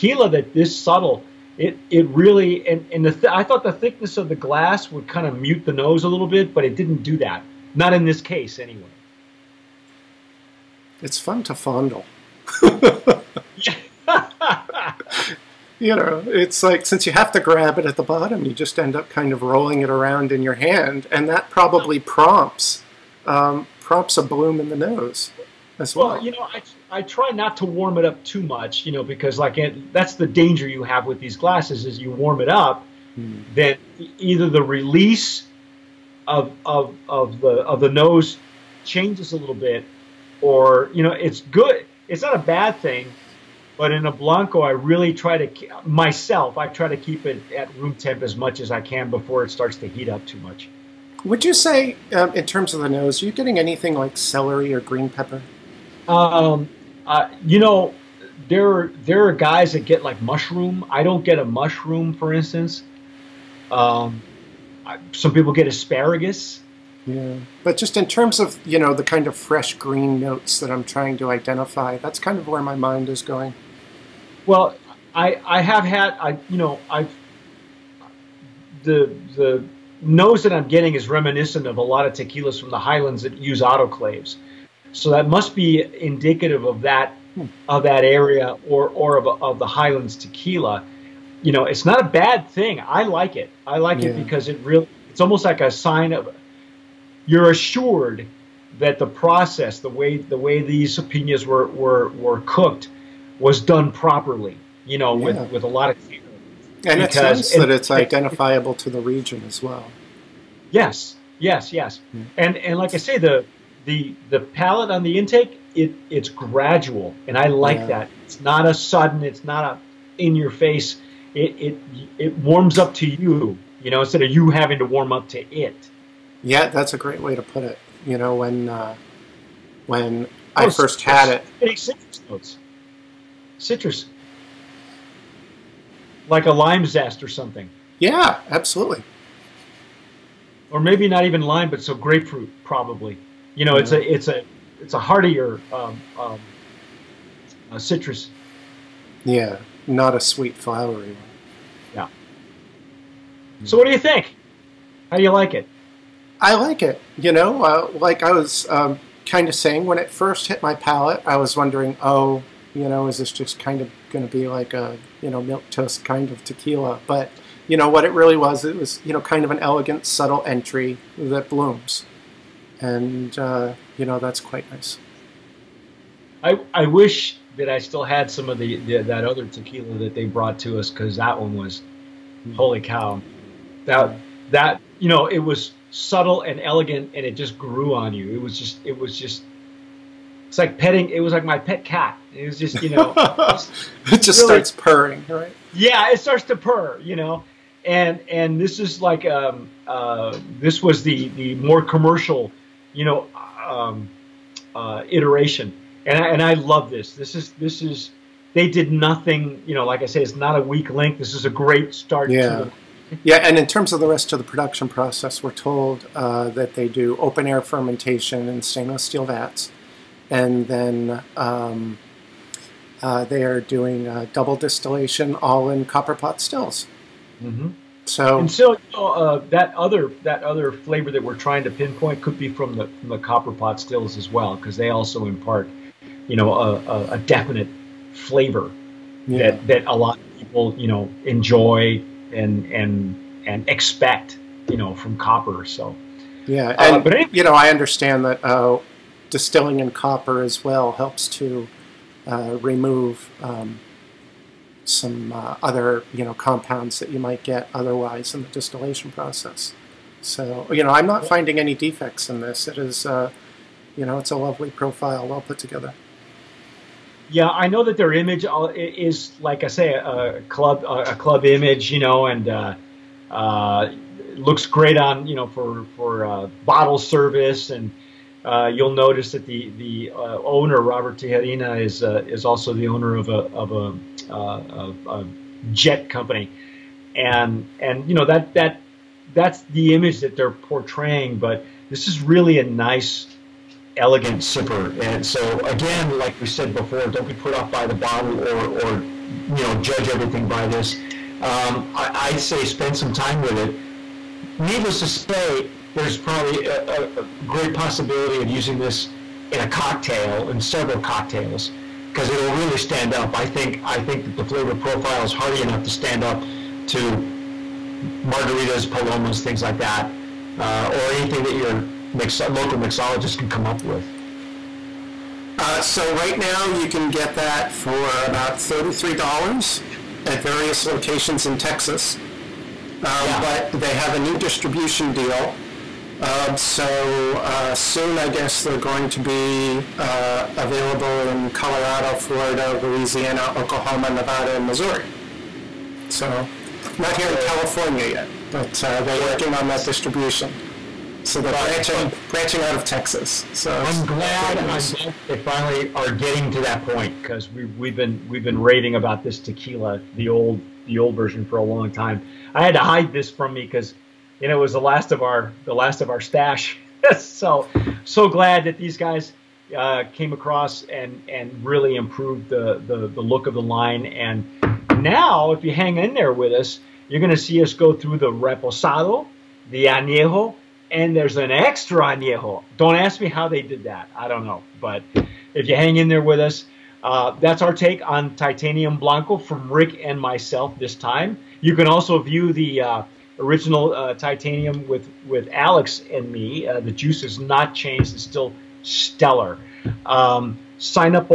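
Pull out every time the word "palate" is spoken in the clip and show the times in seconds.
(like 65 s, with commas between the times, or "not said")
114 s, 160 s.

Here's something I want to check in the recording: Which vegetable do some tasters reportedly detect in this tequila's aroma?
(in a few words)
Asparagus.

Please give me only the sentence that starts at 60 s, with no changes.
I don't get a mushroom, for instance.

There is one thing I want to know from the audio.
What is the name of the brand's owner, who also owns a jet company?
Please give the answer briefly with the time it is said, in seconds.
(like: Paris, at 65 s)
Robert Tejerina, at 280 s.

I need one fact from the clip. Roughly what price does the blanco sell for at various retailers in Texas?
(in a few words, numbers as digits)
$33.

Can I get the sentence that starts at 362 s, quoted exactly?
I had to hide this from me because you know it was the last of our the last of our stash.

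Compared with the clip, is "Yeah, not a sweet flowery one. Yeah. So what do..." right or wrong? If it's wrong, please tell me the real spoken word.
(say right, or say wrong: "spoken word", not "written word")
right.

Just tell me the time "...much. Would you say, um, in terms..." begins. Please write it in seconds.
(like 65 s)
50 s.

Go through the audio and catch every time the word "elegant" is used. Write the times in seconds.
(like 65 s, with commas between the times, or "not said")
169 s, 186 s, 293 s.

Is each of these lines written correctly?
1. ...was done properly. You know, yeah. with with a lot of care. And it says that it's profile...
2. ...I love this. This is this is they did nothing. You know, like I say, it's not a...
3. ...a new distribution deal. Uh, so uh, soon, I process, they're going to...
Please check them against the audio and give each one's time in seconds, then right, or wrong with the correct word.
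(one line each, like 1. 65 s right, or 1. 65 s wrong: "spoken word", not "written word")
1. 103 s wrong: "identifiable", not "profile"
2. 206 s right
3. 334 s wrong: "guess", not "process".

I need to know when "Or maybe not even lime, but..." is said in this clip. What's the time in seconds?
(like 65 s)
140 s.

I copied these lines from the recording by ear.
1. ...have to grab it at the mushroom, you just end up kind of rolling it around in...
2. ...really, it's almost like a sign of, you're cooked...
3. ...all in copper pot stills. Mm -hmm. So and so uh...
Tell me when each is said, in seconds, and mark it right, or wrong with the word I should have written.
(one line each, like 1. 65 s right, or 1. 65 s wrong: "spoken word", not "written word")
1. 17 s wrong: "bottom", not "mushroom"
2. 94 s wrong: "assured", not "cooked"
3. 225 s right.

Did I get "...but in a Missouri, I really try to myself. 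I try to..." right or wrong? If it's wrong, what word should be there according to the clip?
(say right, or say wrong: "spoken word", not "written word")
wrong: "Blanco", not "Missouri".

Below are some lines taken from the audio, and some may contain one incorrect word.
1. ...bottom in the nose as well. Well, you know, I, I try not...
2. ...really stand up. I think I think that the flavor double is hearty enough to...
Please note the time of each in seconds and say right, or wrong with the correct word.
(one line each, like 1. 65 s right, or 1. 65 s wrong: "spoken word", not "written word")
1. 24 s wrong: "bloom", not "bottom"
2. 312 s wrong: "profile", not "double".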